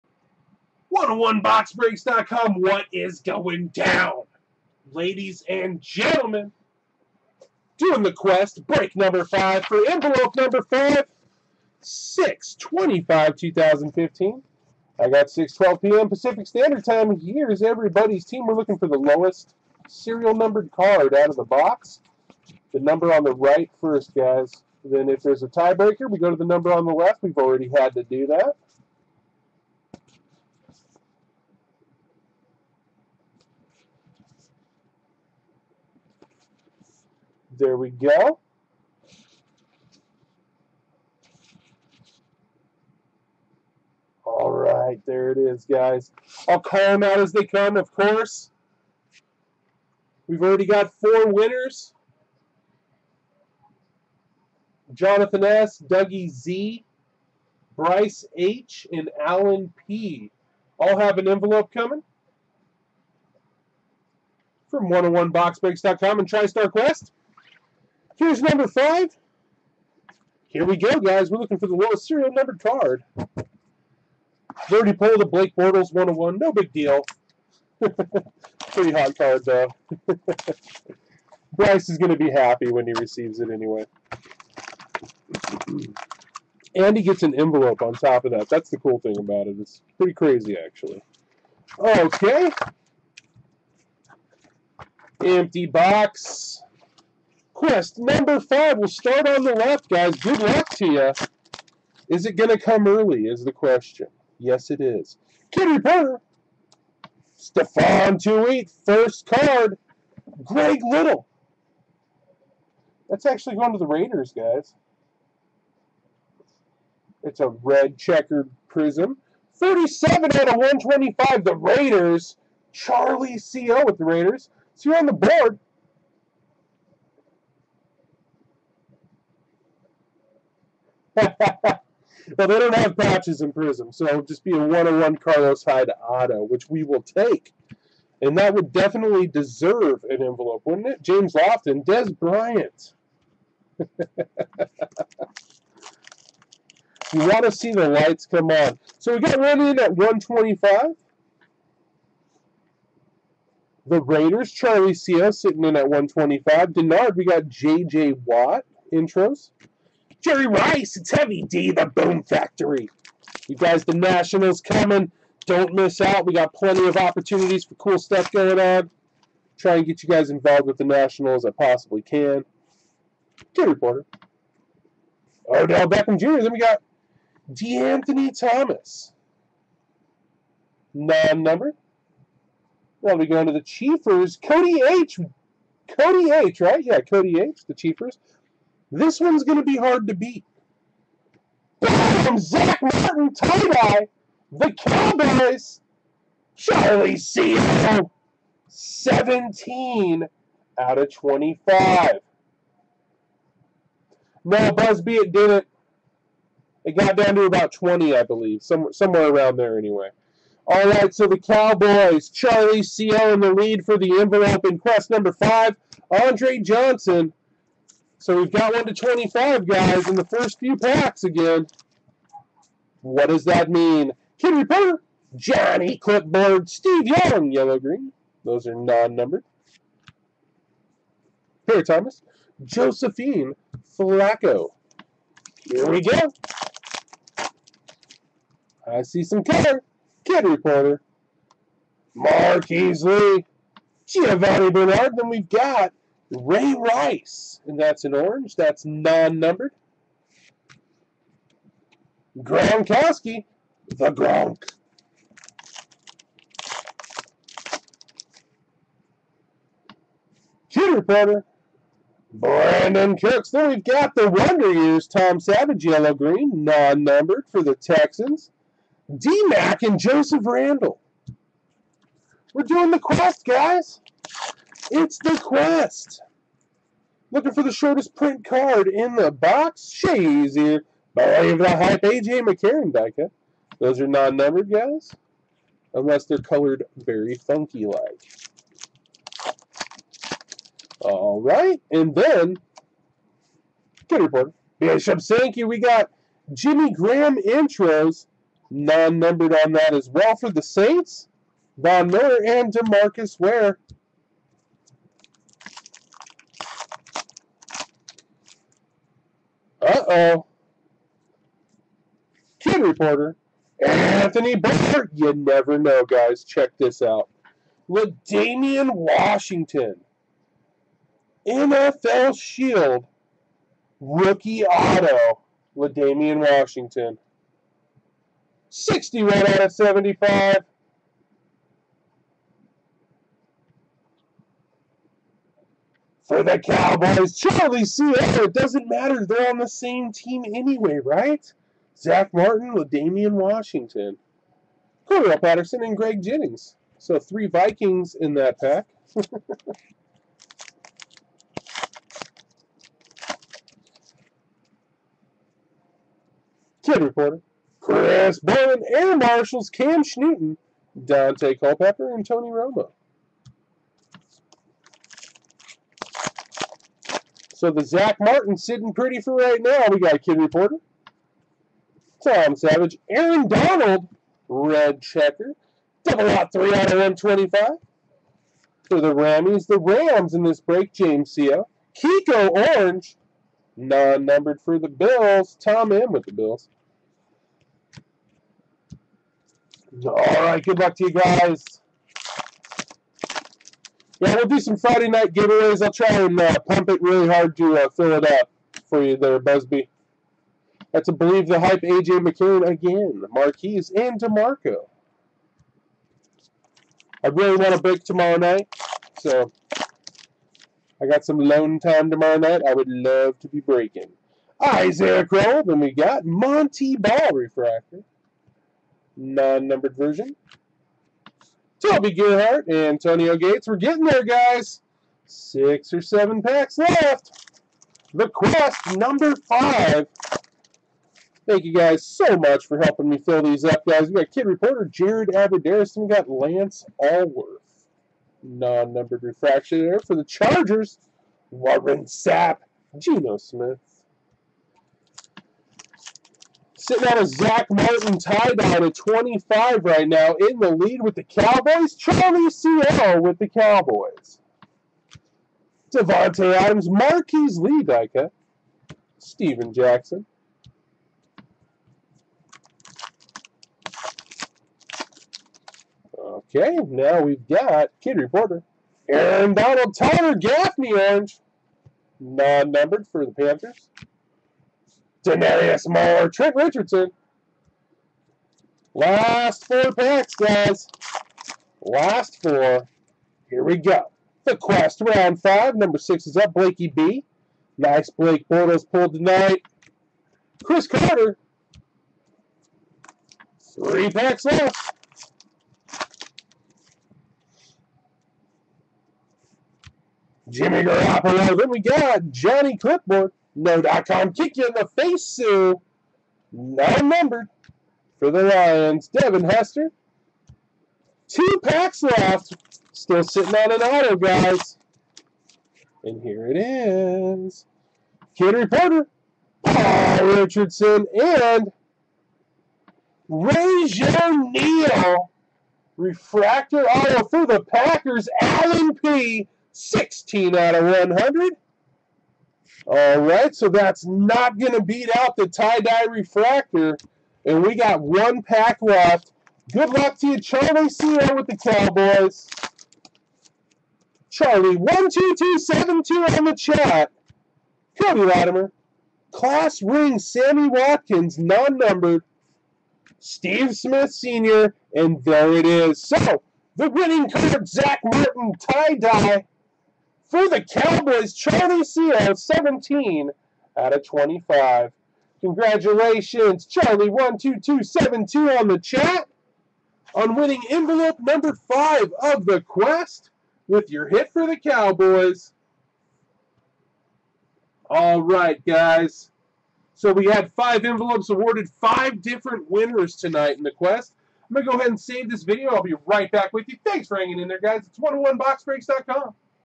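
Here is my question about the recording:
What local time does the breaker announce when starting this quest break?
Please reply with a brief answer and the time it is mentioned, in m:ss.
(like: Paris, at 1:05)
6:12 p.m., at 0:15.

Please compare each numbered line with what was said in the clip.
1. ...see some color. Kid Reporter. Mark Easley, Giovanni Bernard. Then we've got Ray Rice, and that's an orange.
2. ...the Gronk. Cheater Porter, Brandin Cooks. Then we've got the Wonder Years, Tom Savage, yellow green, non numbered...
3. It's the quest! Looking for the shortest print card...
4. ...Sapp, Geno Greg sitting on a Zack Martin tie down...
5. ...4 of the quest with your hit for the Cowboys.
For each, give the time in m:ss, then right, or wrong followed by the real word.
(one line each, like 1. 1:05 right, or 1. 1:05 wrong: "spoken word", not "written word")
1. 3:59 right
2. 4:13 right
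3. 4:34 right
4. 7:22 wrong: "Smith", not "Greg"
5. 9:31 wrong: "5", not "4".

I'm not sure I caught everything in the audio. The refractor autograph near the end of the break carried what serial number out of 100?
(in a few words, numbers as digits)
16.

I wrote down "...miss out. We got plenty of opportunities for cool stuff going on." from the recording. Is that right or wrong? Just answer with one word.
right.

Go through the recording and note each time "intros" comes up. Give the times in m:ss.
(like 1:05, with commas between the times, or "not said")
2:38, 4:57.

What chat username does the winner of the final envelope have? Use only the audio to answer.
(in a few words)
Charlie12272.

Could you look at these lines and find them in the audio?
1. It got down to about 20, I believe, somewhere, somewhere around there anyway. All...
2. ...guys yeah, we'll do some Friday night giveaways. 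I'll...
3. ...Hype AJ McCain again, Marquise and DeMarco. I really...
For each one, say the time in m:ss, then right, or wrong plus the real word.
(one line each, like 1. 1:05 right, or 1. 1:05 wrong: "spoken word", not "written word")
1. 3:26 right
2. 6:31 right
3. 6:41 right.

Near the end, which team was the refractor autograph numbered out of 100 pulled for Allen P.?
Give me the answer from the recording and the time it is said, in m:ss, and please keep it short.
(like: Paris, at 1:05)
Packers, at 8:47.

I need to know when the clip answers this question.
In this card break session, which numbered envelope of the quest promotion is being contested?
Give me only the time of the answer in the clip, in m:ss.
0:09.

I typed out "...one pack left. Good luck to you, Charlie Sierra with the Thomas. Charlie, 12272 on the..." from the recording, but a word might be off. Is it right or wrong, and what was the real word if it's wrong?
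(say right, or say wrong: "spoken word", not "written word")
wrong: "Cowboys", not "Thomas".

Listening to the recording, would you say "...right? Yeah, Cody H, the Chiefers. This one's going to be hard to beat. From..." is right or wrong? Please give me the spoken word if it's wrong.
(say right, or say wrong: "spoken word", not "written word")
right.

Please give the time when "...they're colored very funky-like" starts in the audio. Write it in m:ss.
4:46.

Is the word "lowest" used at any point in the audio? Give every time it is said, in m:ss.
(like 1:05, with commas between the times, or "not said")
0:18, 1:11.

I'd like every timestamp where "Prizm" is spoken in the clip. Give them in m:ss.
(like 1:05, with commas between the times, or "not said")
1:58, 2:13.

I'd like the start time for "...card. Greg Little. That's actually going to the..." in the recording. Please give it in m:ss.
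1:49.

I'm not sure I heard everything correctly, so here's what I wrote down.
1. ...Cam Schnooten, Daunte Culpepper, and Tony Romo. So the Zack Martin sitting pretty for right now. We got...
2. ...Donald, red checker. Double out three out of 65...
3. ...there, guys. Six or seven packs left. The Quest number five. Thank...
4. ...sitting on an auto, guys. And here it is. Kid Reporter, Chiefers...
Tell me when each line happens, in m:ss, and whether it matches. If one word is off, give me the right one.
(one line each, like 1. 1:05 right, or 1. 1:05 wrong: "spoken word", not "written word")
1. 5:59 right
2. 6:13 wrong: "25", not "65"
3. 7:04 right
4. 8:33 wrong: "Paul", not "Chiefers".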